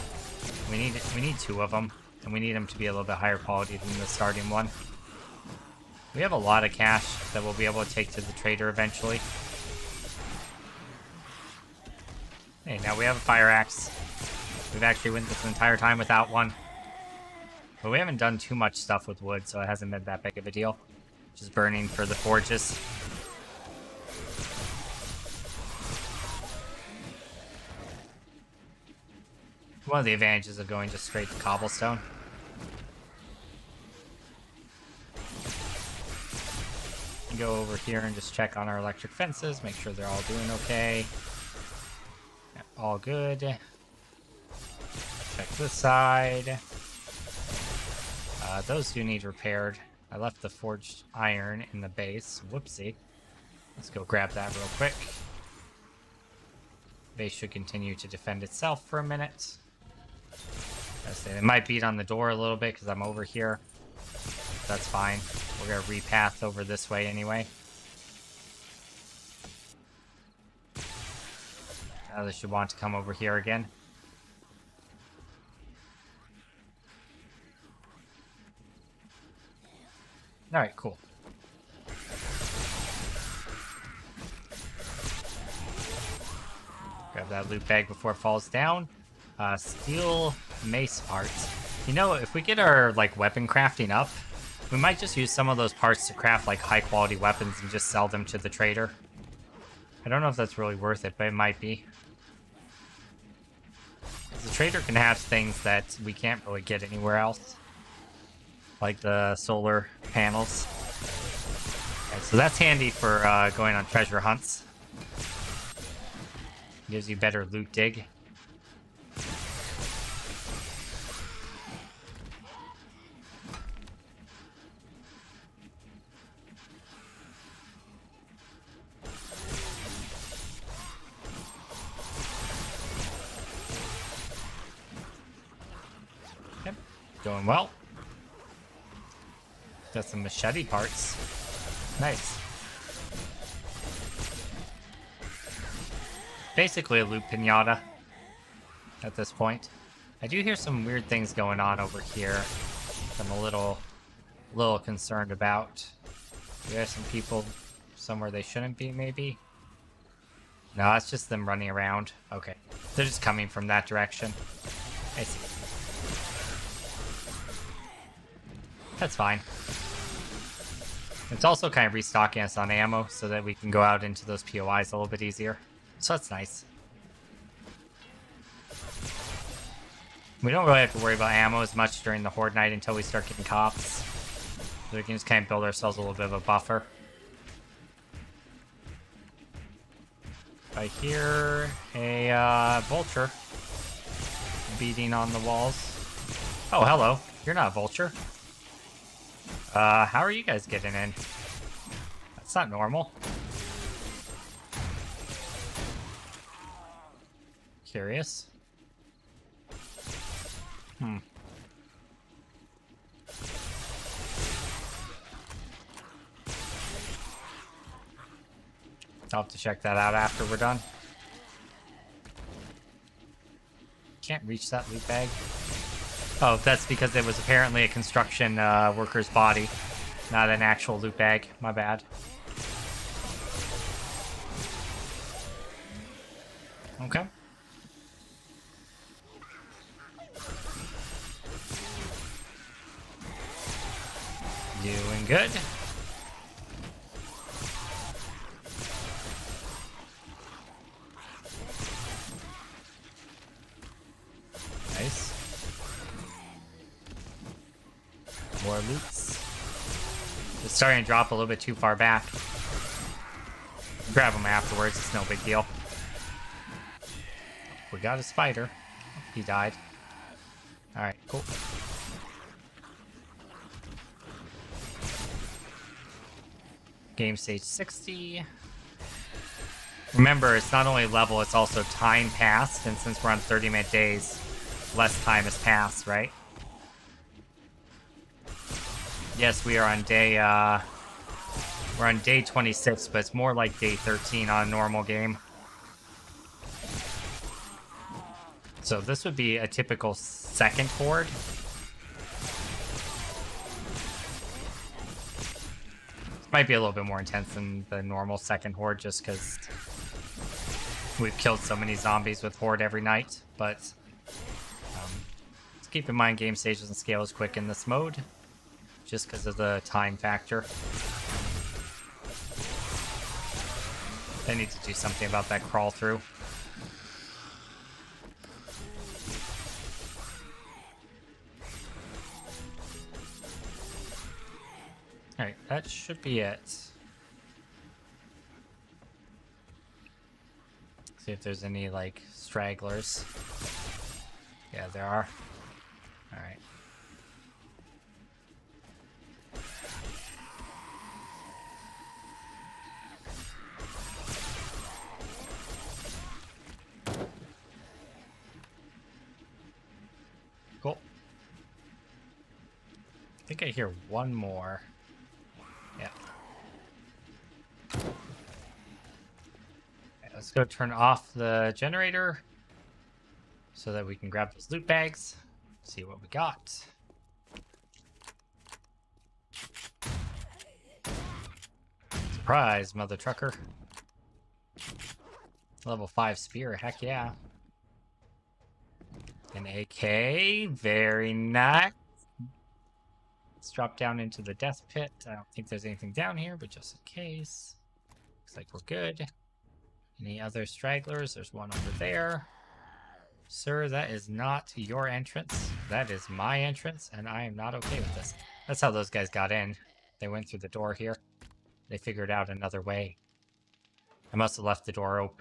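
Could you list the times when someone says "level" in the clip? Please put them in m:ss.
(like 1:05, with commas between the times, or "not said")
4:41, 6:25.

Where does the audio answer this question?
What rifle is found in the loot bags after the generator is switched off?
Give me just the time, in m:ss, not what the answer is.
6:29.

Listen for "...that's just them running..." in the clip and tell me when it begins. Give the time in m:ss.
2:40.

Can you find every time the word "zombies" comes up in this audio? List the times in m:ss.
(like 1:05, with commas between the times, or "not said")
5:11.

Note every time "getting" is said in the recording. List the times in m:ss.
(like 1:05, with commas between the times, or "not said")
3:03, 3:20.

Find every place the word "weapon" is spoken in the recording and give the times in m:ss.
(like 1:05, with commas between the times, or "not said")
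1:33, 1:37.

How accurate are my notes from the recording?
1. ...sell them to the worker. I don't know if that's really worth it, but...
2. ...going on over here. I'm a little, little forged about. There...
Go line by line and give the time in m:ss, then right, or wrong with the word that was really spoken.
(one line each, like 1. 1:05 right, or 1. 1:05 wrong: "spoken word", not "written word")
1. 1:37 wrong: "trader", not "worker"
2. 2:31 wrong: "concerned", not "forged".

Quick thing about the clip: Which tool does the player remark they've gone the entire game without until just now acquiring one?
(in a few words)
Fire axe.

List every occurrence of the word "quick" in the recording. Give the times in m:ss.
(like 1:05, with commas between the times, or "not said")
0:54, 5:17.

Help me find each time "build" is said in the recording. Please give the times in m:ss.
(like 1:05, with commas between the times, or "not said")
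3:05.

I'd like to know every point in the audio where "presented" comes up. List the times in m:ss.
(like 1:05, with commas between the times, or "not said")
not said.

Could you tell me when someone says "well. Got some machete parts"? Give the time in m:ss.
2:17.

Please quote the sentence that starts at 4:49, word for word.
Yes, we are on day, uh, we're on day 26, but it's more like day 13 on a normal game.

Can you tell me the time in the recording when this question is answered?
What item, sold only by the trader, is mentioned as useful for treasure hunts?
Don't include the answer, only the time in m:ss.
1:49.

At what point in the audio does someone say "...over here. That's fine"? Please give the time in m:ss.
1:03.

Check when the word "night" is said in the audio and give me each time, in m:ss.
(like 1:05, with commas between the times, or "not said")
3:02, 5:13.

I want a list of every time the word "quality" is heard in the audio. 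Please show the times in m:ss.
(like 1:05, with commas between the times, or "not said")
0:03, 1:36.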